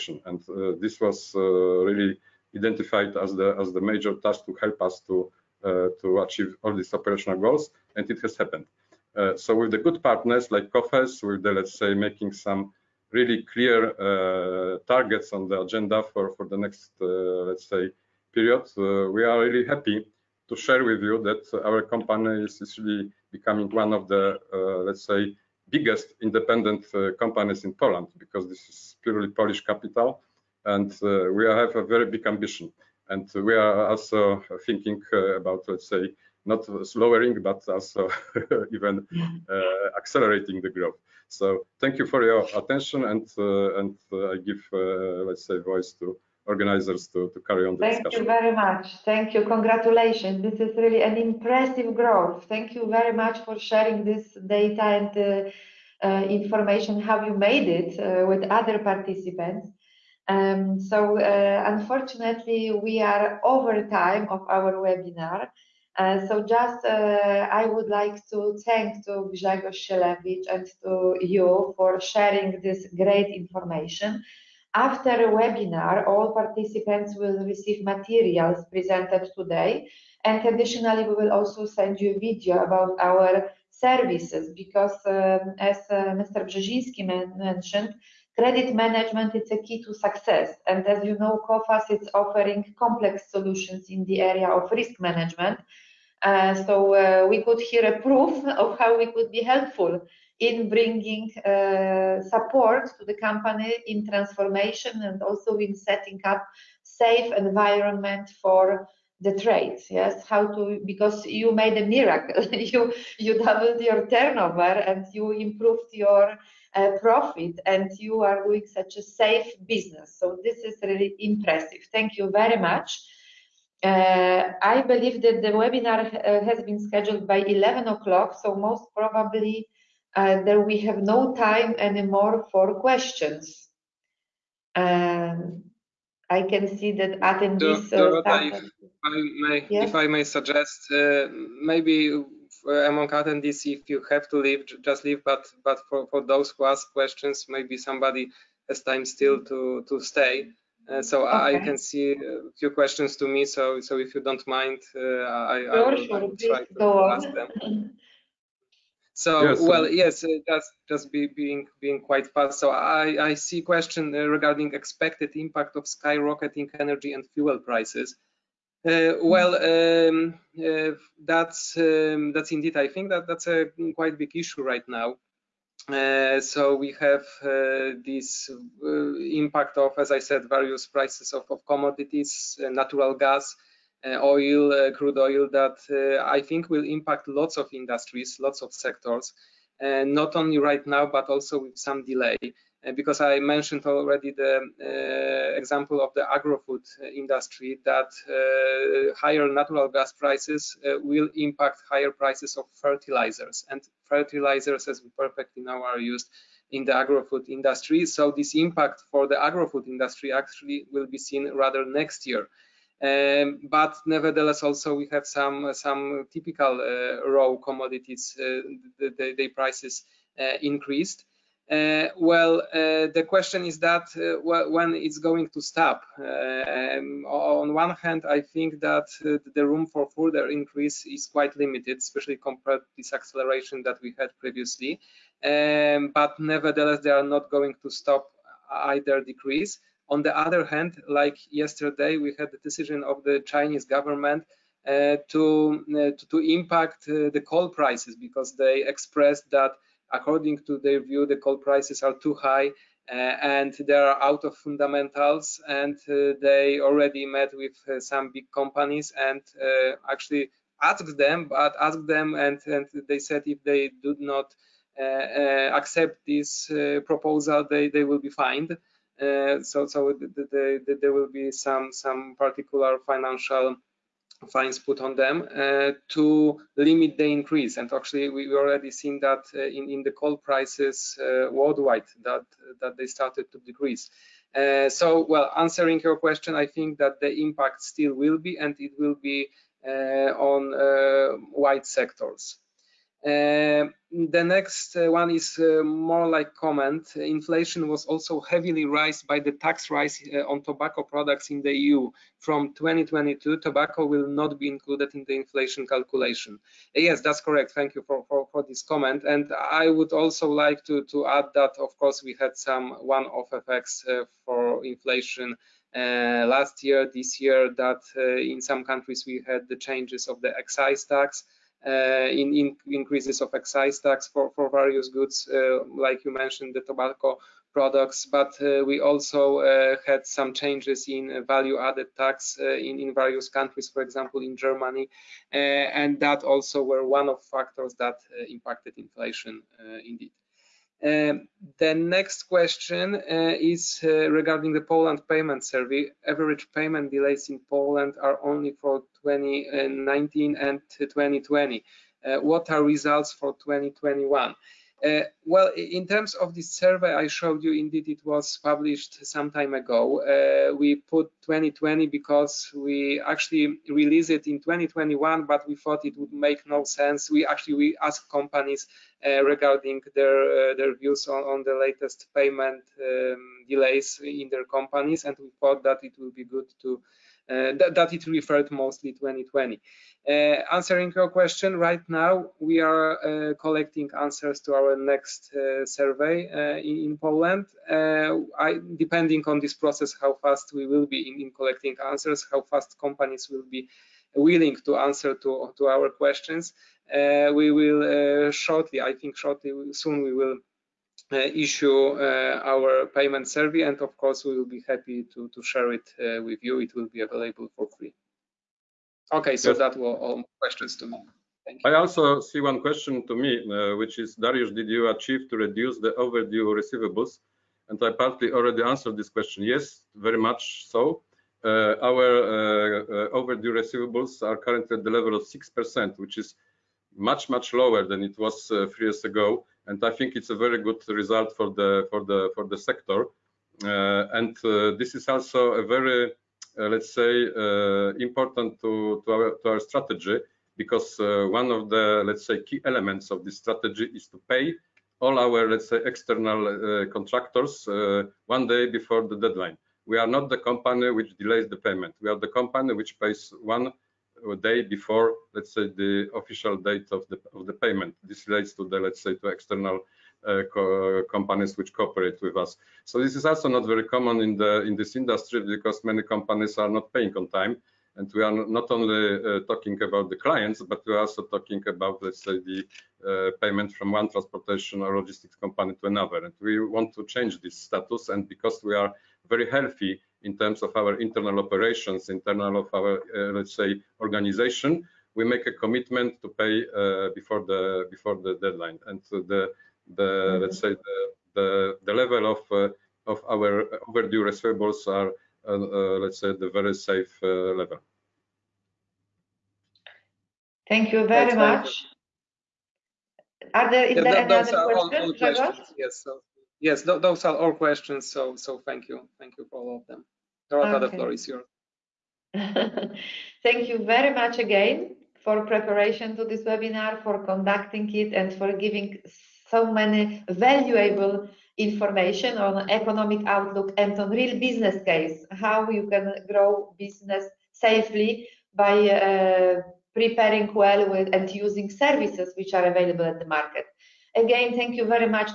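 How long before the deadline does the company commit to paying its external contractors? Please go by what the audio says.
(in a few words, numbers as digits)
one day.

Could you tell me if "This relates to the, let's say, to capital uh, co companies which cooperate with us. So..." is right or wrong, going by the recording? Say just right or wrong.
wrong.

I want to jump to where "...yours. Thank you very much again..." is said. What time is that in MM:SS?
08:31.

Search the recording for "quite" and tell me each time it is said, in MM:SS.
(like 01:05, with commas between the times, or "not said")
02:42, 02:53, 03:51.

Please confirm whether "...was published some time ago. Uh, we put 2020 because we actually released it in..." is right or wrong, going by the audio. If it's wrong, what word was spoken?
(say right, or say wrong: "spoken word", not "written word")
right.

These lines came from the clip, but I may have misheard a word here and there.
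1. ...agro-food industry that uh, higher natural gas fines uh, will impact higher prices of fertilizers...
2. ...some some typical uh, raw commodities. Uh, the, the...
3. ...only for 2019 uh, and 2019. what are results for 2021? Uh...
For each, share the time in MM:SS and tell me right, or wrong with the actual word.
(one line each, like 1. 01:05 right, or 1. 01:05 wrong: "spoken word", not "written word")
1. 03:16 wrong: "prices", not "fines"
2. 03:35 right
3. 05:48 wrong: "2020", not "2019".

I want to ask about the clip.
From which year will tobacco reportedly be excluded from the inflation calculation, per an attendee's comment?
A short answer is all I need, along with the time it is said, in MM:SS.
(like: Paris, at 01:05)
2022, at 05:02.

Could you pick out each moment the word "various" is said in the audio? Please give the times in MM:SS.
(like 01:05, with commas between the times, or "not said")
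03:00, 05:24, 05:33.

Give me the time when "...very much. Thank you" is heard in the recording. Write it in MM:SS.
00:48.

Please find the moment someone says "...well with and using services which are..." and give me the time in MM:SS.
08:50.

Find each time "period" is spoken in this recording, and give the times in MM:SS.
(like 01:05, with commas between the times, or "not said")
00:18.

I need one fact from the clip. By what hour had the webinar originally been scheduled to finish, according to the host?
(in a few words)
11 o'clock.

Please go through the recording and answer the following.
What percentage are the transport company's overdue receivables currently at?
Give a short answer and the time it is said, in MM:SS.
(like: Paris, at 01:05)
6%, at 07:05.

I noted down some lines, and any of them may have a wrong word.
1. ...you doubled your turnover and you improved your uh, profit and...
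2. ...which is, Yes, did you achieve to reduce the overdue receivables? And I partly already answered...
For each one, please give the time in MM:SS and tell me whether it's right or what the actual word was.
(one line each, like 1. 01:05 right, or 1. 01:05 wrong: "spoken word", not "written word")
1. 01:53 right
2. 06:53 wrong: "Darius", not "Yes".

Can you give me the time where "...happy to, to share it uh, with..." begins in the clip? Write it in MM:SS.
06:44.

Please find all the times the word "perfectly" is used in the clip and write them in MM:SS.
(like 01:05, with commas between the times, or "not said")
03:25.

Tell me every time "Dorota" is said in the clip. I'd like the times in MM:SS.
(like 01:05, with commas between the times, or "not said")
02:17, 08:30.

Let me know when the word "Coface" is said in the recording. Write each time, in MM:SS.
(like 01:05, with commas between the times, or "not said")
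00:10, 01:31.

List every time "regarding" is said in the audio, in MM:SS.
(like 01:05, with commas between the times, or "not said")
02:44, 05:44, 06:09.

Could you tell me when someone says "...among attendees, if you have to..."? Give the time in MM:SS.
02:22.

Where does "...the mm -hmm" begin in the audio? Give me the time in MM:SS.
08:10.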